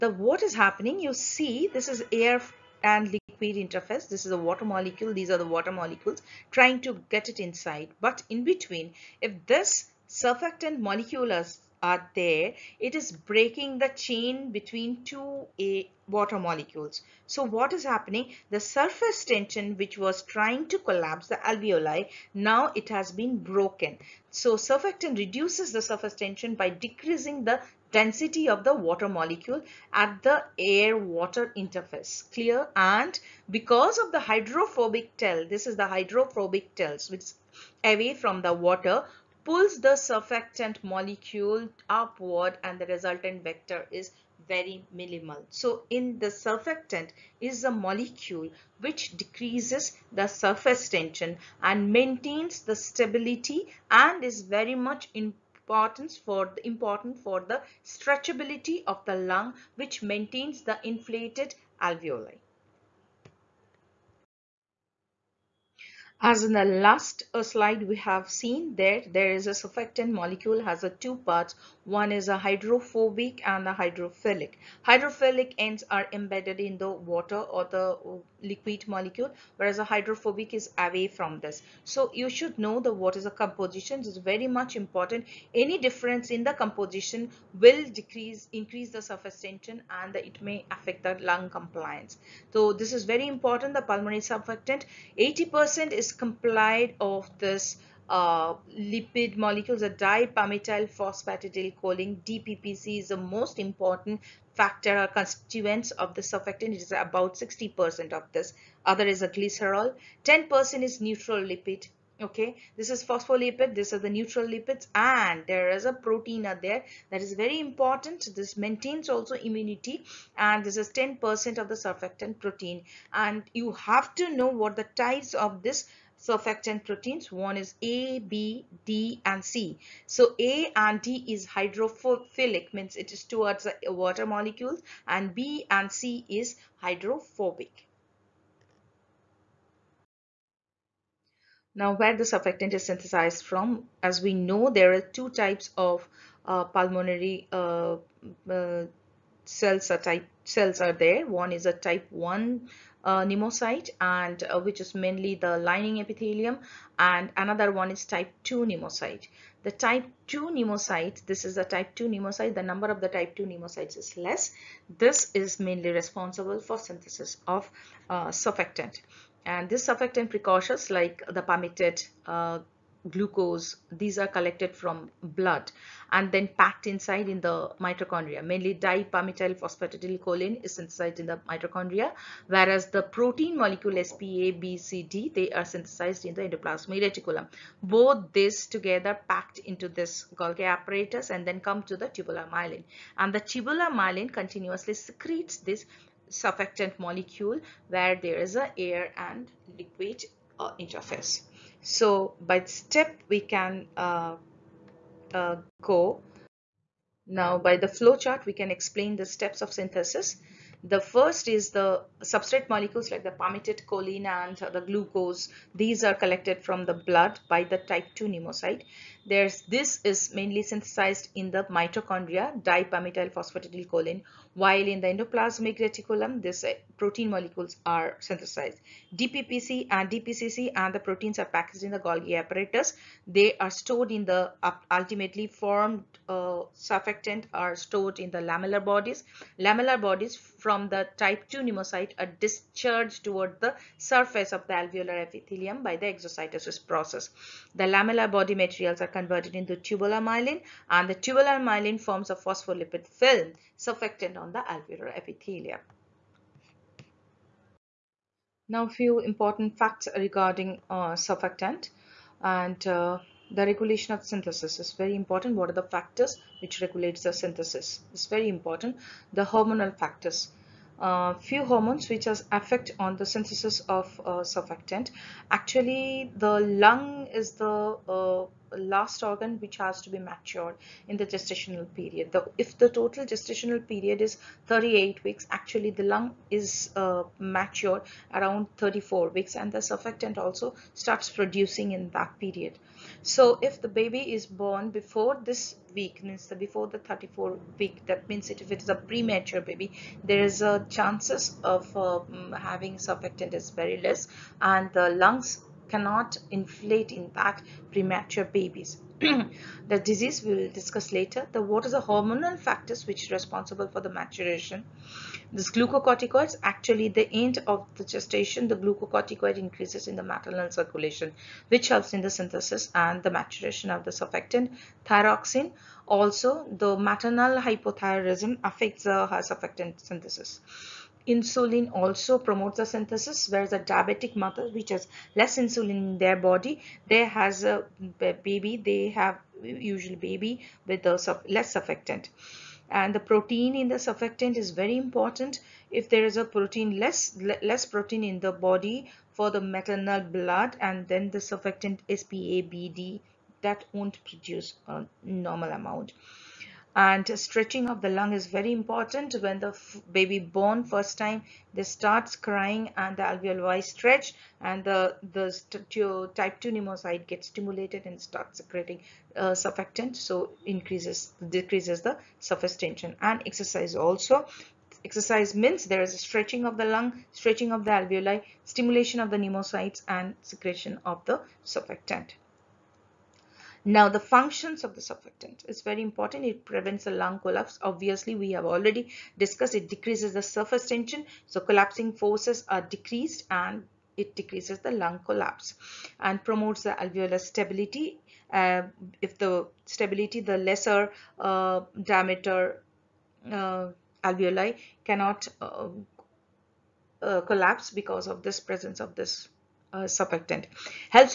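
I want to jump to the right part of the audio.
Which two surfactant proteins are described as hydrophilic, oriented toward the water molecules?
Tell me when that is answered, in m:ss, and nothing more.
2:10.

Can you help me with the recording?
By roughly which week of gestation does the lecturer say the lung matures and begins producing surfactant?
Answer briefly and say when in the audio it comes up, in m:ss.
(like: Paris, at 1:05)
34 weeks, at 4:48.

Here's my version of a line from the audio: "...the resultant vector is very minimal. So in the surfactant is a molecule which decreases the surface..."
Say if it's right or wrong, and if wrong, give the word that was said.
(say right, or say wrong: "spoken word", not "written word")
right.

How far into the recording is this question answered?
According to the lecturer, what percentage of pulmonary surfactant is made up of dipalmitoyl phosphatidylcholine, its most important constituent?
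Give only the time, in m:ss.
1:47.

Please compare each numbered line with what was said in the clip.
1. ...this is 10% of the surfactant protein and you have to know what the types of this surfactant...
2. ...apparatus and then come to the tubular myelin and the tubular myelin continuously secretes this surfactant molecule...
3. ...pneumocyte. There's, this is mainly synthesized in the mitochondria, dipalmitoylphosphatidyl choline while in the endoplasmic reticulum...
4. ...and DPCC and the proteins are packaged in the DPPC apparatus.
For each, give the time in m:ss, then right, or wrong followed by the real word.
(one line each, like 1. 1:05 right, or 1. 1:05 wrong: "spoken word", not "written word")
1. 2:00 right
2. 3:10 right
3. 3:38 right
4. 3:49 wrong: "Golgi", not "DPPC".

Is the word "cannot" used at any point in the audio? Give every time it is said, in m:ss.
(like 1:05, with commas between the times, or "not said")
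5:05, 6:45.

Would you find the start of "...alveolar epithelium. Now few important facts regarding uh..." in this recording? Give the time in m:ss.
4:14.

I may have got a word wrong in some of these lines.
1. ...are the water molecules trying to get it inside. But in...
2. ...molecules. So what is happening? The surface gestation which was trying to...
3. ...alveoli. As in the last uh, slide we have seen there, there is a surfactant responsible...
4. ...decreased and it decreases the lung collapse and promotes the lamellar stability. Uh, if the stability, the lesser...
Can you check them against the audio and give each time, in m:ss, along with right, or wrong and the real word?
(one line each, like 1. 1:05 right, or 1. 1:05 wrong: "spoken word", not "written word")
1. 0:05 right
2. 0:16 wrong: "tension", not "gestation"
3. 1:01 wrong: "molecule", not "responsible"
4. 6:32 wrong: "alveolar", not "lamellar".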